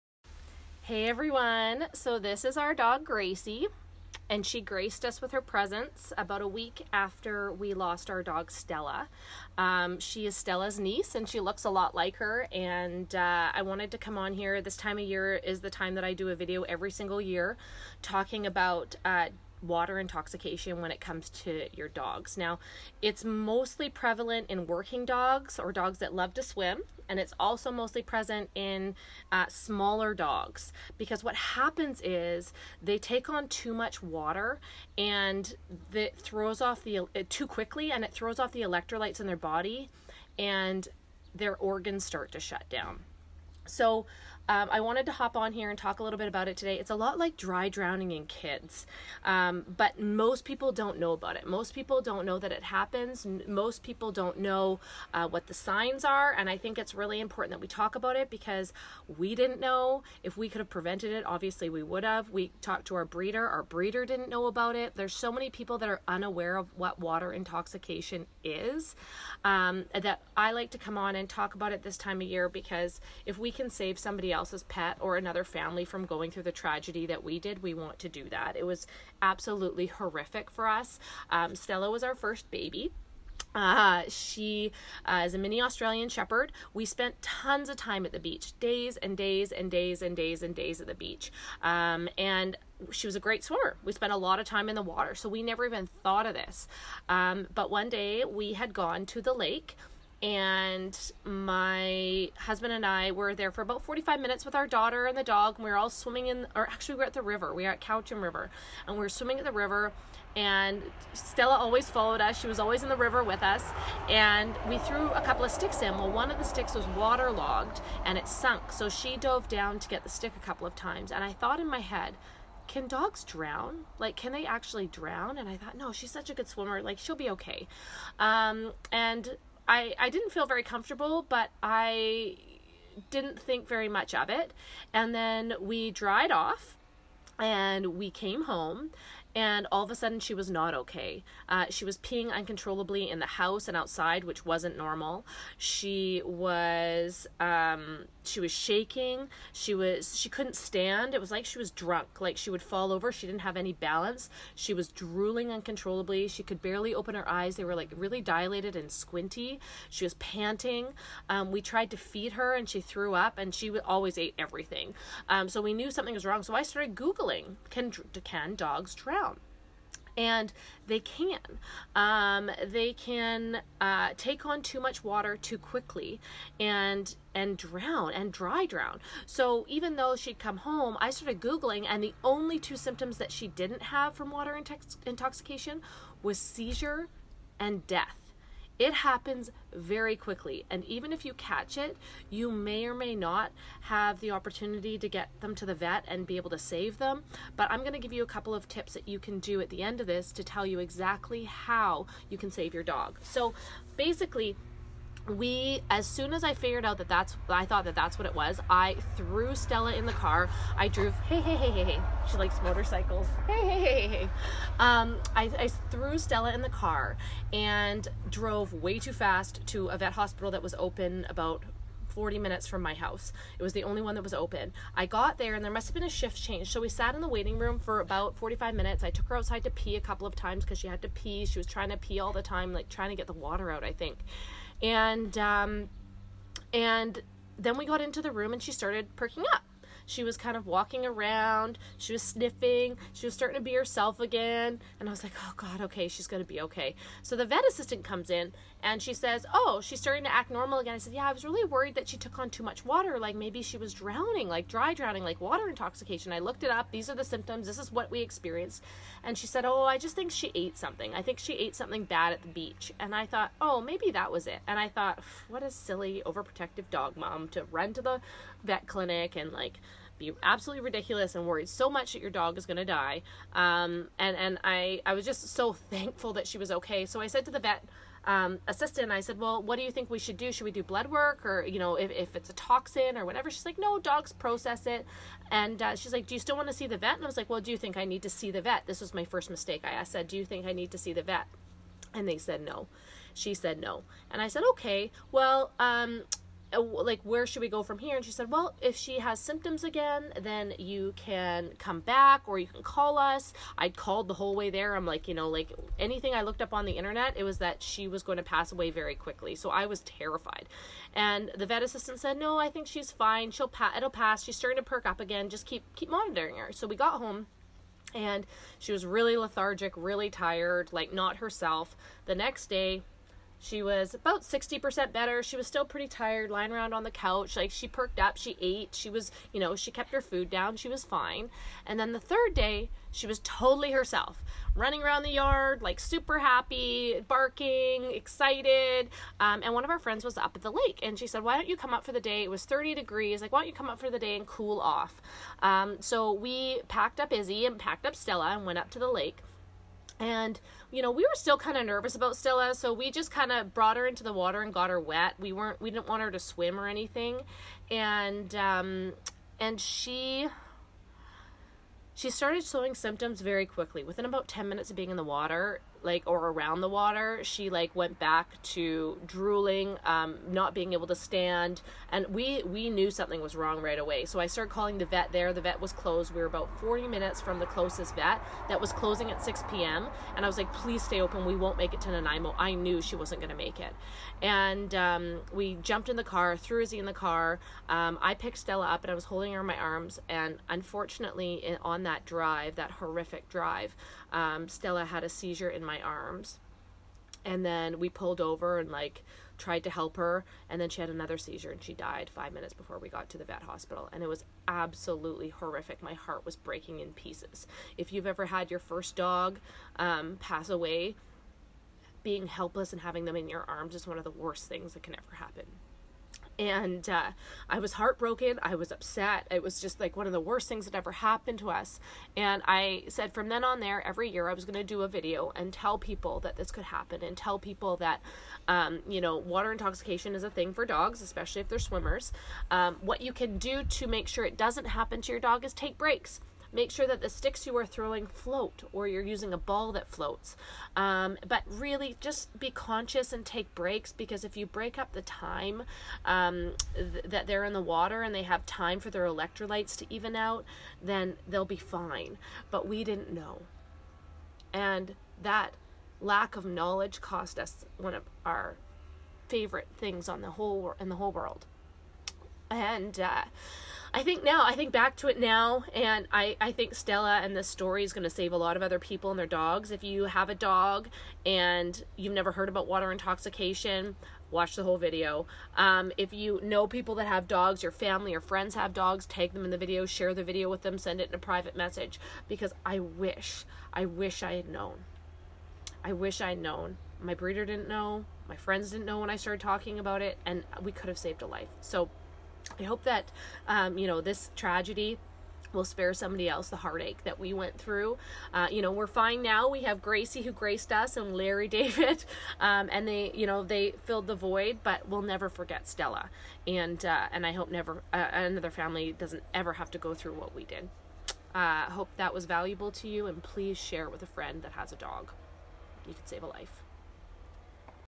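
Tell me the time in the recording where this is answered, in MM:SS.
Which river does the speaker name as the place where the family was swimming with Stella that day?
01:47.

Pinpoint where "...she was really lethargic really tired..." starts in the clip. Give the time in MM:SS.
05:18.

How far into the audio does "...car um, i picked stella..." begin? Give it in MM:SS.
06:27.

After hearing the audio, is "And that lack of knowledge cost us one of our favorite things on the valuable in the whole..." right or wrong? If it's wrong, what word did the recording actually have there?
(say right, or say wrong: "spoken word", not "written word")
wrong: "whole", not "valuable".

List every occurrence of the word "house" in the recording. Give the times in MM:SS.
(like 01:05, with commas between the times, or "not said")
02:23, 03:42.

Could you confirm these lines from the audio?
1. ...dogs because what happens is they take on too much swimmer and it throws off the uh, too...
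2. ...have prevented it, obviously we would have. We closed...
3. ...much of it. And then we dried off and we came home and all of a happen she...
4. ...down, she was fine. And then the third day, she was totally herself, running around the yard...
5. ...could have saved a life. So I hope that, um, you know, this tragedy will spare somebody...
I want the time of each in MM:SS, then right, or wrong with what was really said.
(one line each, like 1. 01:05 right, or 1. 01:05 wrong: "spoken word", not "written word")
1. 00:30 wrong: "water", not "swimmer"
2. 01:00 wrong: "talked", not "closed"
3. 02:13 wrong: "sudden", not "happen"
4. 05:30 right
5. 08:10 right.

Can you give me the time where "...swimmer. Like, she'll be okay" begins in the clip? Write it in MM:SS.
02:06.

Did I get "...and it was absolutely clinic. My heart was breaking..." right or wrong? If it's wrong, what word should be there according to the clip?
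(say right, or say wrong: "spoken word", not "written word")
wrong: "horrific", not "clinic".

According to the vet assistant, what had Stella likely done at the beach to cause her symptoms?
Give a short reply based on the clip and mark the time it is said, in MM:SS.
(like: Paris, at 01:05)
Ate something bad, at 04:21.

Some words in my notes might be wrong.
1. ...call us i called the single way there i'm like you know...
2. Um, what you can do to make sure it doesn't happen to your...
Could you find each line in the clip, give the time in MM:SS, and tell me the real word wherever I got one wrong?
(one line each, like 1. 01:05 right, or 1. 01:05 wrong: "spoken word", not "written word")
1. 05:02 wrong: "whole", not "single"
2. 07:12 right.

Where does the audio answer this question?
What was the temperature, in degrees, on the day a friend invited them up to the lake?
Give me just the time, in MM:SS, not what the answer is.
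05:42.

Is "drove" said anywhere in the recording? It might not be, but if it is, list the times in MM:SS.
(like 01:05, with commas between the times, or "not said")
03:30, 03:38.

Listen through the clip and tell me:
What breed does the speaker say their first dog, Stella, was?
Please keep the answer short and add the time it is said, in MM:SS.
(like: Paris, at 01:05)
Mini Australian Shepherd, at 01:25.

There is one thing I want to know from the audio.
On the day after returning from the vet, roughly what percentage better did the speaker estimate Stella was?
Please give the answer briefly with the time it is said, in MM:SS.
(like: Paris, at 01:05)
60%, at 05:24.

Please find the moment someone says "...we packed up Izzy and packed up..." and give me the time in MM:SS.
05:46.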